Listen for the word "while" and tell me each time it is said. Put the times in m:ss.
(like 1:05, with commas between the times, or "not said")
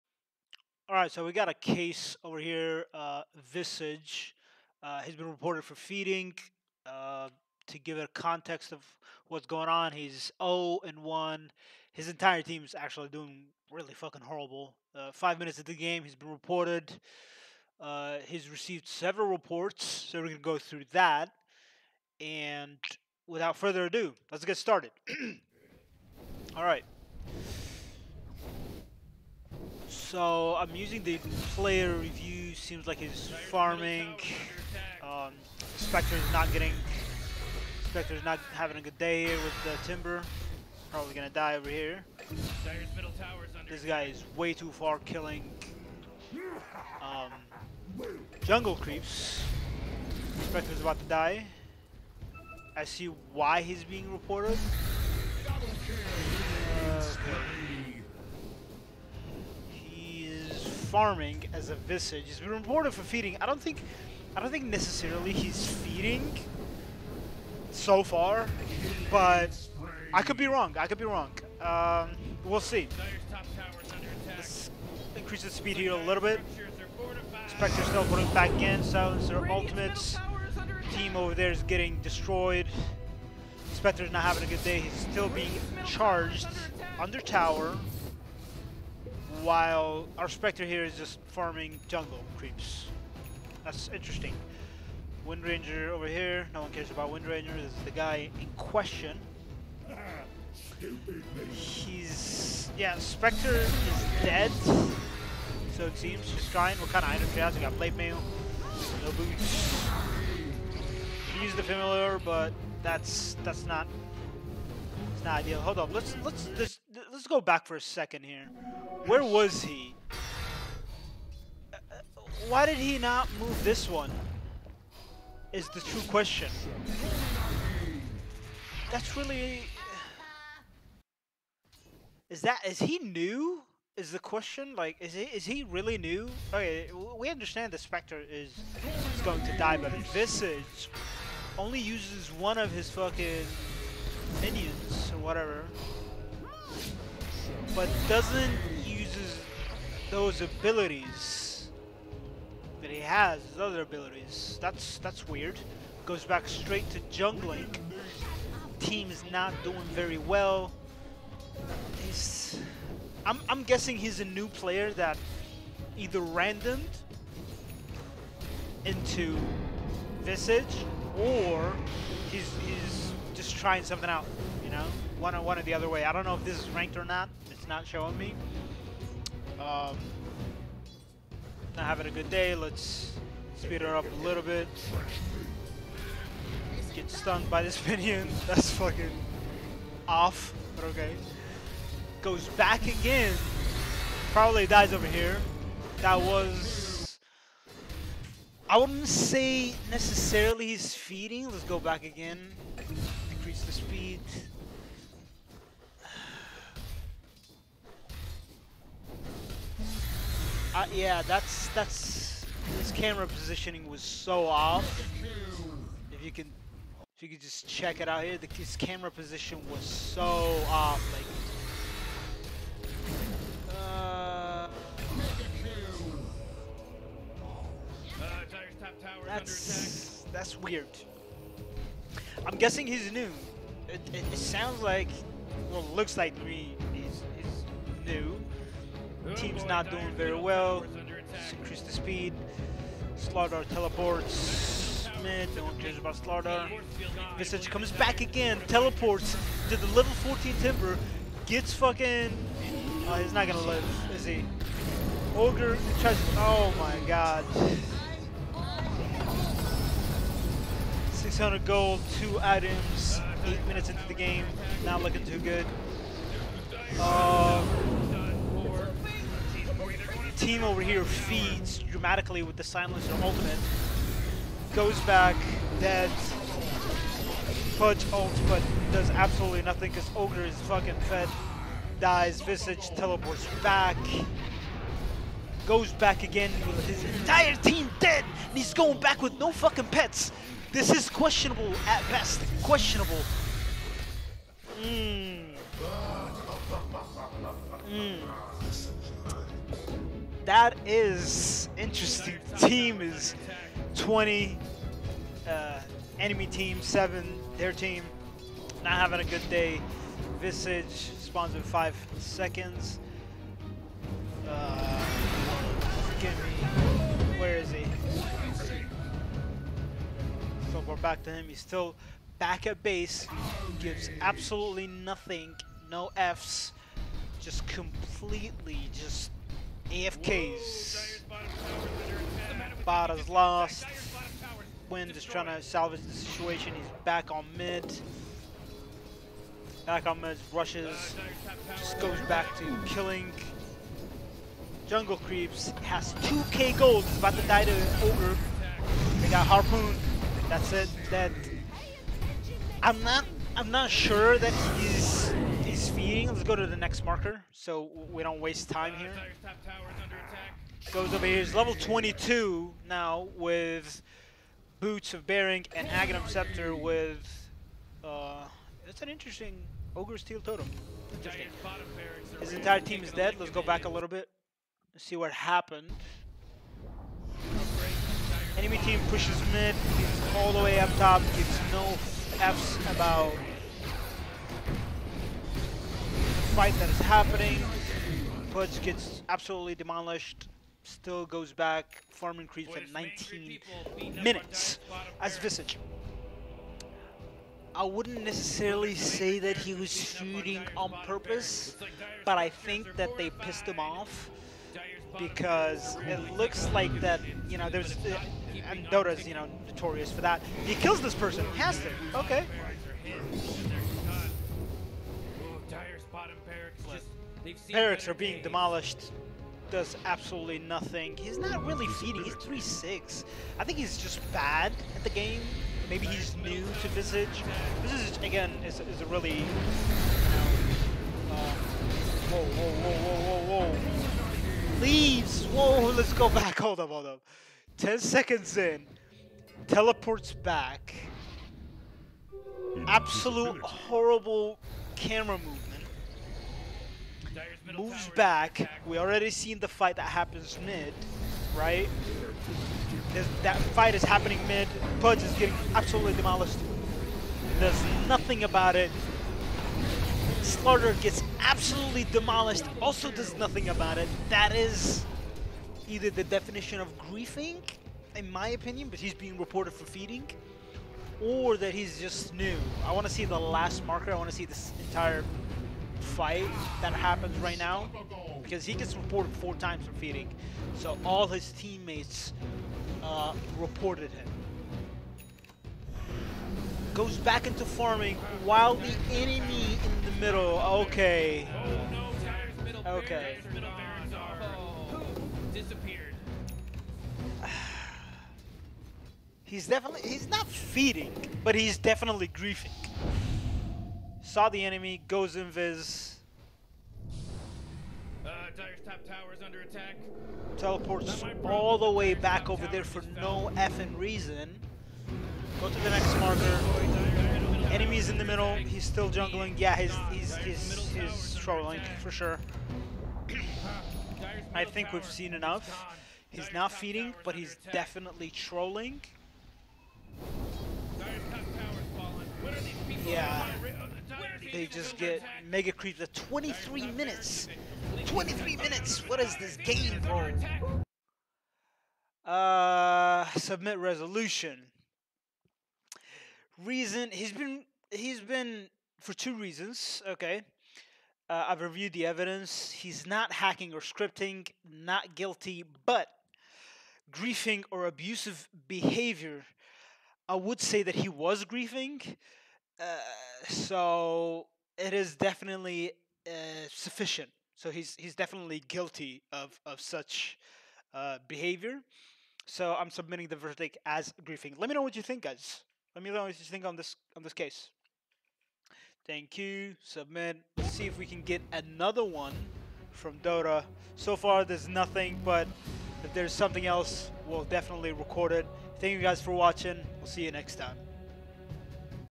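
1:29, 8:08.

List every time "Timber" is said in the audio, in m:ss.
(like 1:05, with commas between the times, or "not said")
0:39, 4:10.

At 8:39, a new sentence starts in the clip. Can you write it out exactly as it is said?
Yeah, he's he's he's, he's, trolling for sure.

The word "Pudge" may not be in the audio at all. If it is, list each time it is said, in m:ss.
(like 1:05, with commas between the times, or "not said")
6:28, 7:34.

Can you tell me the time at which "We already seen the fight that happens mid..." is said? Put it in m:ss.
7:28.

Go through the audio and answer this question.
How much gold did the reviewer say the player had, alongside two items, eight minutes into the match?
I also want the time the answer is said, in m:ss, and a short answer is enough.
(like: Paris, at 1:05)
600, at 4:21.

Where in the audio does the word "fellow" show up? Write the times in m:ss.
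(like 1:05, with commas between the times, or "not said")
not said.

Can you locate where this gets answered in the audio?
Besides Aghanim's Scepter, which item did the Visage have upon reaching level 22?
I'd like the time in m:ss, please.
6:04.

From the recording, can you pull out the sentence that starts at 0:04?
Uh, he's been reported for feeding.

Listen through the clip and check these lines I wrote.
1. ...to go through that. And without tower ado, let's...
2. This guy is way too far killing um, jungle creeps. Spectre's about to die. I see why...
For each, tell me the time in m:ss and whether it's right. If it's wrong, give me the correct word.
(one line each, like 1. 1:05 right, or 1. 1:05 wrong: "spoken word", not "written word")
1. 0:20 wrong: "further", not "tower"
2. 0:43 right.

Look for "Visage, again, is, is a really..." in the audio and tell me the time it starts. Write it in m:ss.
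7:07.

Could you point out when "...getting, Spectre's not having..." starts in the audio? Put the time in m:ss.
0:36.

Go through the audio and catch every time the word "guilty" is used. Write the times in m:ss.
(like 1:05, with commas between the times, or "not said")
9:15, 9:28.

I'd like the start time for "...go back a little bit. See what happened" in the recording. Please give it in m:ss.
6:13.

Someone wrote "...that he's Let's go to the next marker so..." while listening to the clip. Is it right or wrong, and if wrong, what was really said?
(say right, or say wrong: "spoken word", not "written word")
right.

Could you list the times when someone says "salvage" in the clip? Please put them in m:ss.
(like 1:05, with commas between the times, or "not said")
5:35.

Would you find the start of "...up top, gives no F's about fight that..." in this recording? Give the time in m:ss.
6:20.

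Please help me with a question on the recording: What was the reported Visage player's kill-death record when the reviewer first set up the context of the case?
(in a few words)
0 and 1.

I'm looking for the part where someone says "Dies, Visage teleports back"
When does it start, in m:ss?
4:41.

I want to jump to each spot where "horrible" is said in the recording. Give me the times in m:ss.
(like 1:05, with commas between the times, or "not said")
0:14, 7:23.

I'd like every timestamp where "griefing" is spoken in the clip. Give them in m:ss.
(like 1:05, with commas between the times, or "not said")
7:46, 8:22, 9:17, 9:21, 9:34.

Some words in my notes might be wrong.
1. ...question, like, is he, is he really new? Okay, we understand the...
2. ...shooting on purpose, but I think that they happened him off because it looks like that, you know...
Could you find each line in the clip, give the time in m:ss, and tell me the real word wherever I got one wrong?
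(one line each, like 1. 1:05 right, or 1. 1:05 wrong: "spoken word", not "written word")
1. 2:14 right
2. 6:39 wrong: "pissed", not "happened".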